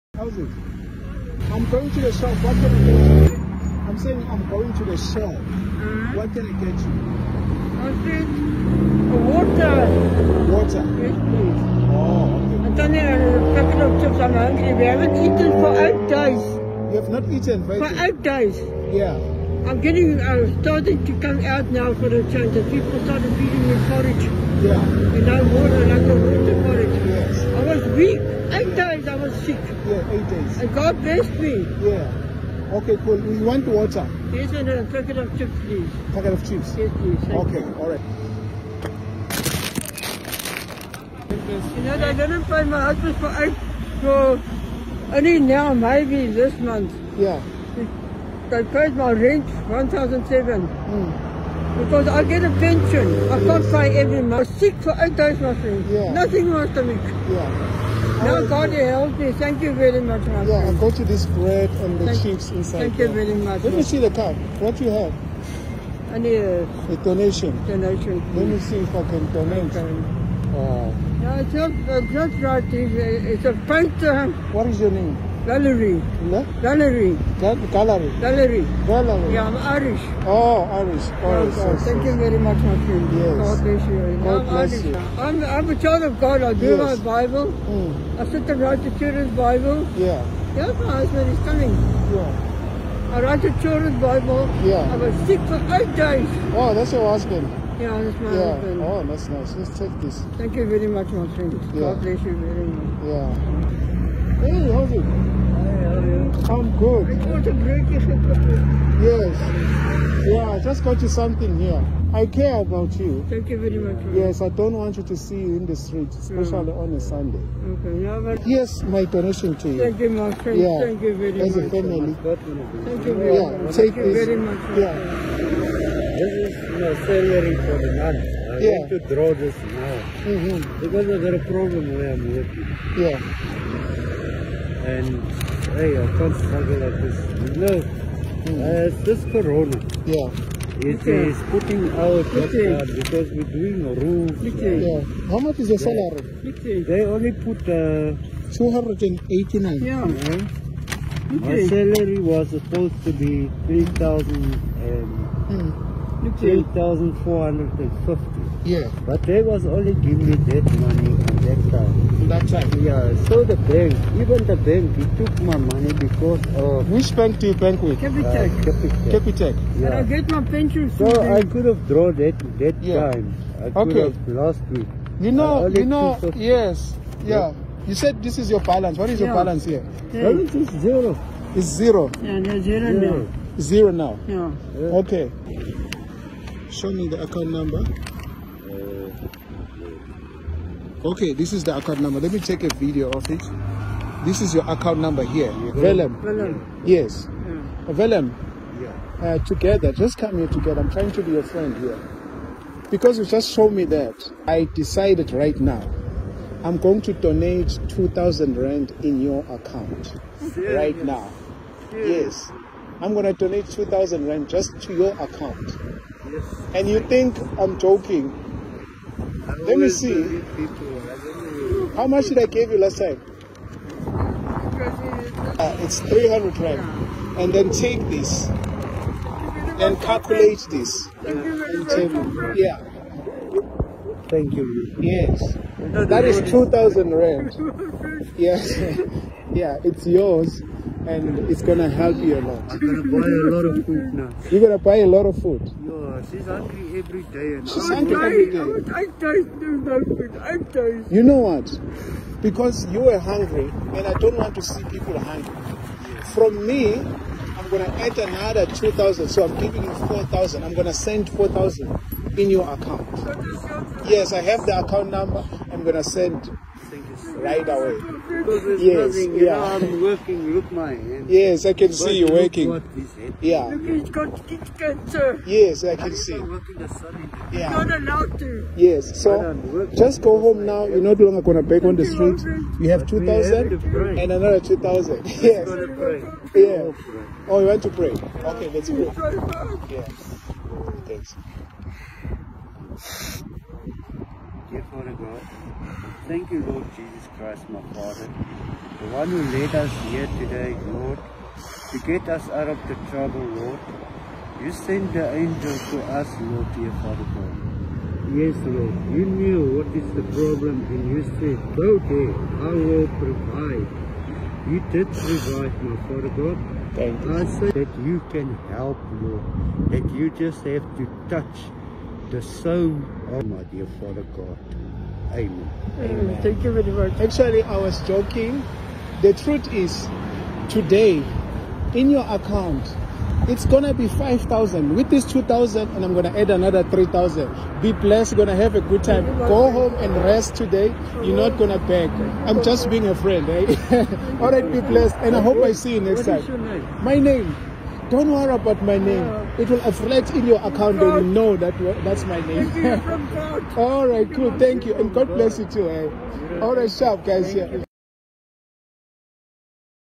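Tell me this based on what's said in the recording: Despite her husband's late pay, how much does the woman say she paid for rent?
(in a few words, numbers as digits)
1,007.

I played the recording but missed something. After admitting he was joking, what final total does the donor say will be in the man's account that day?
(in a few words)
5,000.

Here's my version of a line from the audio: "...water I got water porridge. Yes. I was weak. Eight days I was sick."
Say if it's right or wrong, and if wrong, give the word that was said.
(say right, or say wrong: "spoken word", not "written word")
right.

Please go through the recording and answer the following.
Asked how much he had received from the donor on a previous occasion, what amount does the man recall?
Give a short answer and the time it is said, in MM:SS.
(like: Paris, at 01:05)
300 rand, at 03:45.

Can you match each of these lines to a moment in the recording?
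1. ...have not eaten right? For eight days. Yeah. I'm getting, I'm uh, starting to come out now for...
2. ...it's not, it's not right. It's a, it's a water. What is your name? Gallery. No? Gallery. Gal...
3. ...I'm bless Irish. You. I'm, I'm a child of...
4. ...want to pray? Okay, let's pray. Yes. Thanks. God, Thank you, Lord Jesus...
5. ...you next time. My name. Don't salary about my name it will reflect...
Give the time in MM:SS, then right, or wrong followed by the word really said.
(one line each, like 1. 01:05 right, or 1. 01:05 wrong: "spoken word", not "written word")
1. 00:17 right
2. 01:11 wrong: "painter", not "water"
3. 01:24 right
4. 04:47 right
5. 05:45 wrong: "worry", not "salary".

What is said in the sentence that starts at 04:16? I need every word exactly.
From me, I'm gonna add another two thousand.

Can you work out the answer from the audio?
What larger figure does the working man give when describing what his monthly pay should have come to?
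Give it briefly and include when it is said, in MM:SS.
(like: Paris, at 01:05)
8,450, at 02:36.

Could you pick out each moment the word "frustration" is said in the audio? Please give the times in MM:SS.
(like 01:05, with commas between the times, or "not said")
not said.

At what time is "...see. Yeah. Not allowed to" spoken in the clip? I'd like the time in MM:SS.
04:36.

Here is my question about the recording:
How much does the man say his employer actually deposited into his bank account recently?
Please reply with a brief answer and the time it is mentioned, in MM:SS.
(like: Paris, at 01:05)
289, at 02:28.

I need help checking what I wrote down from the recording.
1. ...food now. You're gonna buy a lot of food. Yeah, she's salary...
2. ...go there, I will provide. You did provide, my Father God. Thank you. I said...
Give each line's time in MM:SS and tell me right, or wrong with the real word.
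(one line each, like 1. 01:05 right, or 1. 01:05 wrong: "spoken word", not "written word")
1. 04:03 wrong: "hungry", not "salary"
2. 05:11 right.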